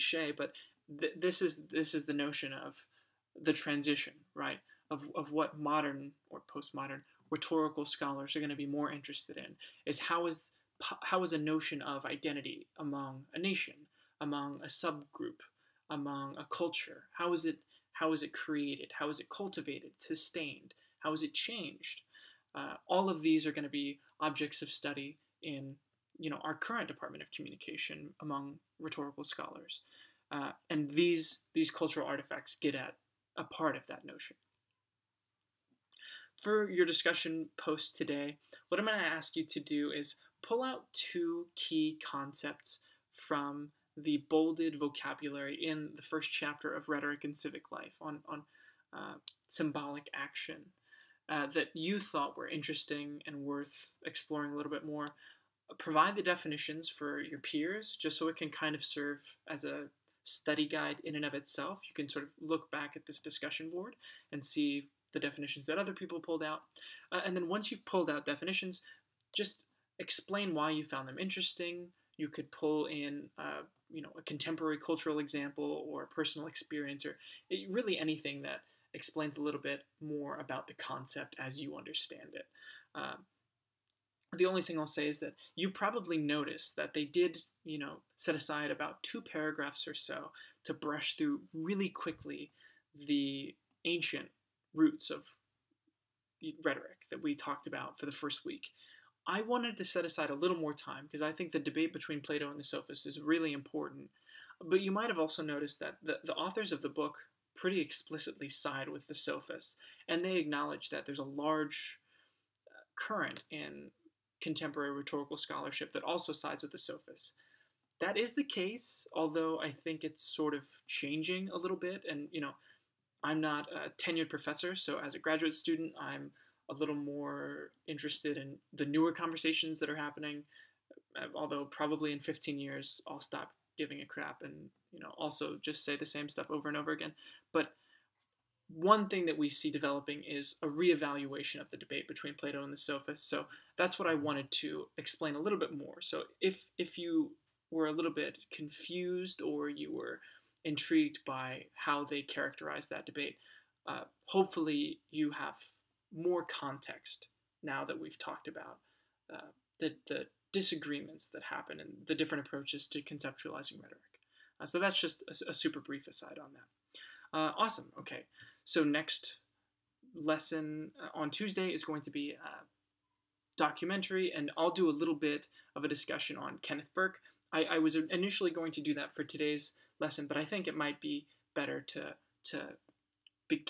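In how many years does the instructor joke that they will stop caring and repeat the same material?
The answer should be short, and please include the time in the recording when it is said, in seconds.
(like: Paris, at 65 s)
15, at 132 s.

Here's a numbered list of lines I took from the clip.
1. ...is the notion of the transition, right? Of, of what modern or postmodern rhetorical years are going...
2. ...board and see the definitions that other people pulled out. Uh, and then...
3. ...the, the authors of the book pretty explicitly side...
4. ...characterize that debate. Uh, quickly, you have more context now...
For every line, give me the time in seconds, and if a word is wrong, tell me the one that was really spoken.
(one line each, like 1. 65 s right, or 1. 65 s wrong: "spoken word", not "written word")
1. 1 s wrong: "scholars", not "years"
2. 63 s right
3. 106 s right
4. 152 s wrong: "hopefully", not "quickly".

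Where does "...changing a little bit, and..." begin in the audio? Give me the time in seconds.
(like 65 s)
120 s.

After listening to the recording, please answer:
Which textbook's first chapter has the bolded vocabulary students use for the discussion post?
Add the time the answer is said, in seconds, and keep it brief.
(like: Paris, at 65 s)
Rhetoric and Civic Life, at 46 s.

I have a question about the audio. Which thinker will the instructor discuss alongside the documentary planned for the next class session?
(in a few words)
Kenneth Burke.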